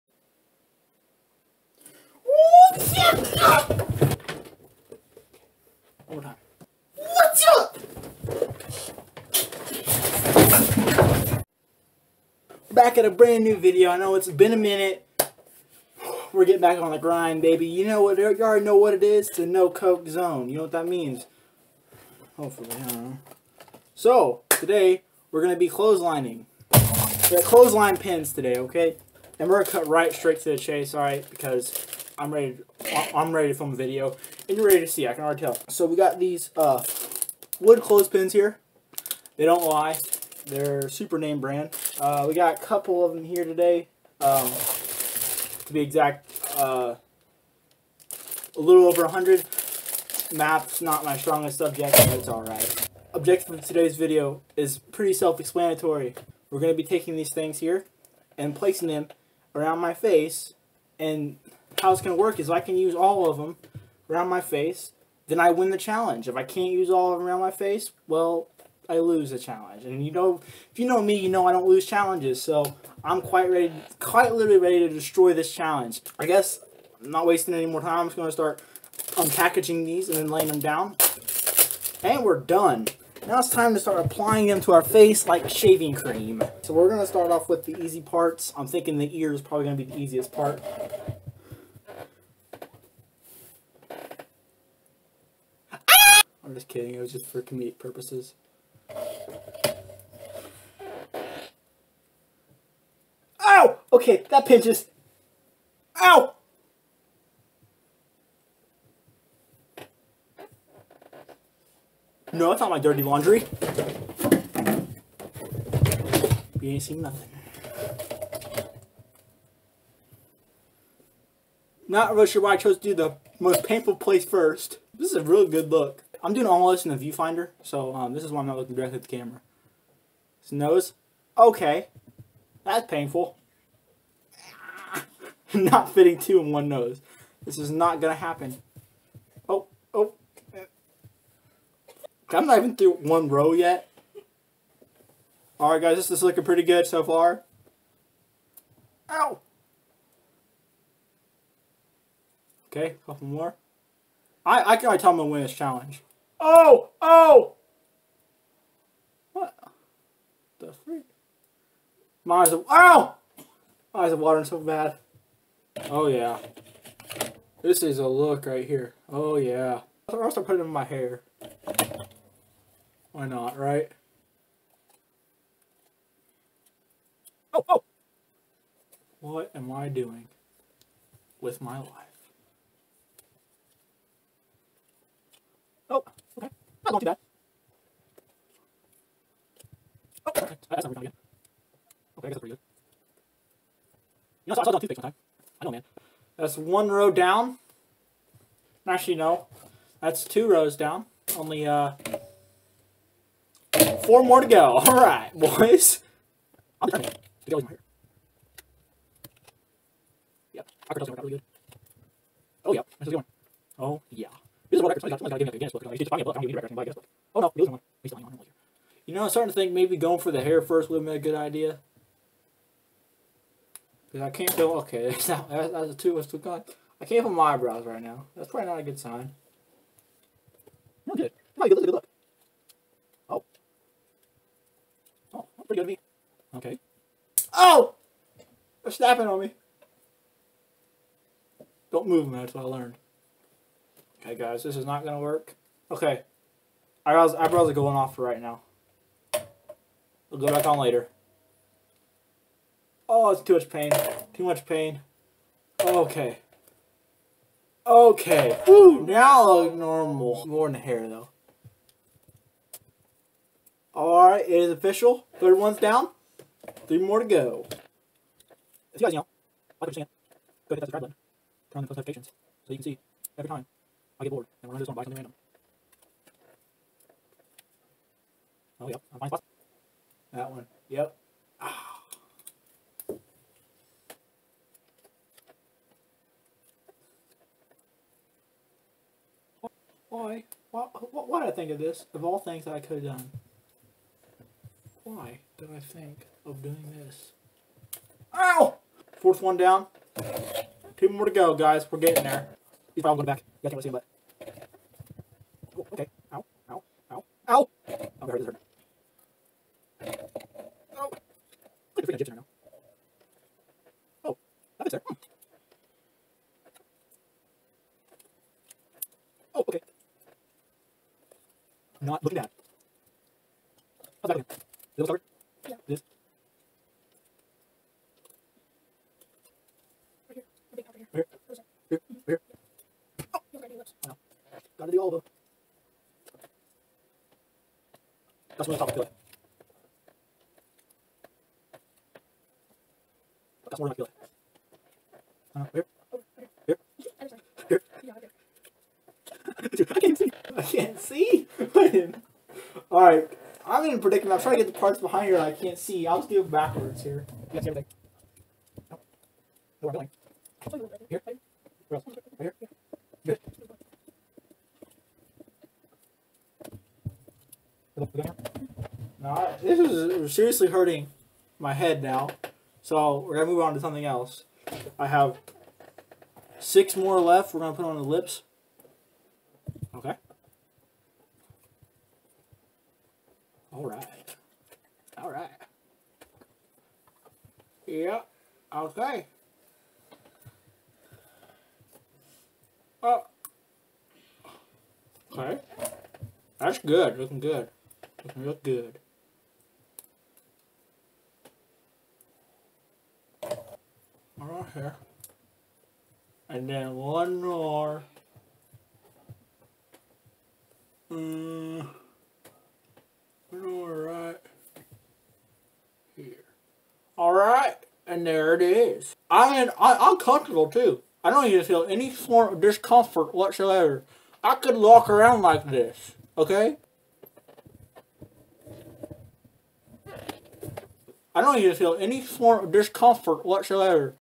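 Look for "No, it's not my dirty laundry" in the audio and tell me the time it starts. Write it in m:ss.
1:52.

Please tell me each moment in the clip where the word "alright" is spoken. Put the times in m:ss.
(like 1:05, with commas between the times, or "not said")
0:52, 2:25, 4:23, 5:52, 6:44, 6:57.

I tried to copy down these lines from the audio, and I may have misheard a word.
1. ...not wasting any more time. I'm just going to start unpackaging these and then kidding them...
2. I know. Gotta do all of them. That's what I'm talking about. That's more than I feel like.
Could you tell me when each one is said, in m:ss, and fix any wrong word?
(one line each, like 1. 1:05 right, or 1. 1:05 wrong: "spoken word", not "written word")
1. 1:17 wrong: "laying", not "kidding"
2. 5:34 right.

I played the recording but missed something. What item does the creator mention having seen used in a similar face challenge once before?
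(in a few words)
Toothpicks.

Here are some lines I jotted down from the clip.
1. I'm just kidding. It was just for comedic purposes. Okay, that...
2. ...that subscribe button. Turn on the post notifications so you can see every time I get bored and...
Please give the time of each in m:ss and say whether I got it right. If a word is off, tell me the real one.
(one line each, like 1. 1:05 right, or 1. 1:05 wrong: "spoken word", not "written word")
1. 1:36 right
2. 4:30 right.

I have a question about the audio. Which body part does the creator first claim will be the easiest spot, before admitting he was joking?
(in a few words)
The ear.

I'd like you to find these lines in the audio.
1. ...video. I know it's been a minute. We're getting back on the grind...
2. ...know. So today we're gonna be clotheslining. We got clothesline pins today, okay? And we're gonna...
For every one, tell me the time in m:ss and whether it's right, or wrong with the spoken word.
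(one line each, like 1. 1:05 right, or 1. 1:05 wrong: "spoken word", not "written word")
1. 0:13 right
2. 0:23 right.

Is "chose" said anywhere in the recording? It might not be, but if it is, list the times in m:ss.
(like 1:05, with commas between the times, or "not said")
2:02.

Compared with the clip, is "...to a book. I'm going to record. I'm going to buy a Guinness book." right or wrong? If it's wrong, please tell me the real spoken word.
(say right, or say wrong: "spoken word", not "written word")
right.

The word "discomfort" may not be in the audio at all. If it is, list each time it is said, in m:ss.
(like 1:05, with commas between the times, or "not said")
7:02, 7:12.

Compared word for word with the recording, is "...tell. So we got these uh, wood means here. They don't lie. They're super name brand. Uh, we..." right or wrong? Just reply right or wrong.
wrong.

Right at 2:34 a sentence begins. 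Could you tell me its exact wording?
I, I can tell I'm going to win this challenge.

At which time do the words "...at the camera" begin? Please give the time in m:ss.
2:08.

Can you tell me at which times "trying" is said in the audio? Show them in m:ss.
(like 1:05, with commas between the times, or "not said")
5:54.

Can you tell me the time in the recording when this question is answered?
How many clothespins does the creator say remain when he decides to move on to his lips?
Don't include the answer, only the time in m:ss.
6:16.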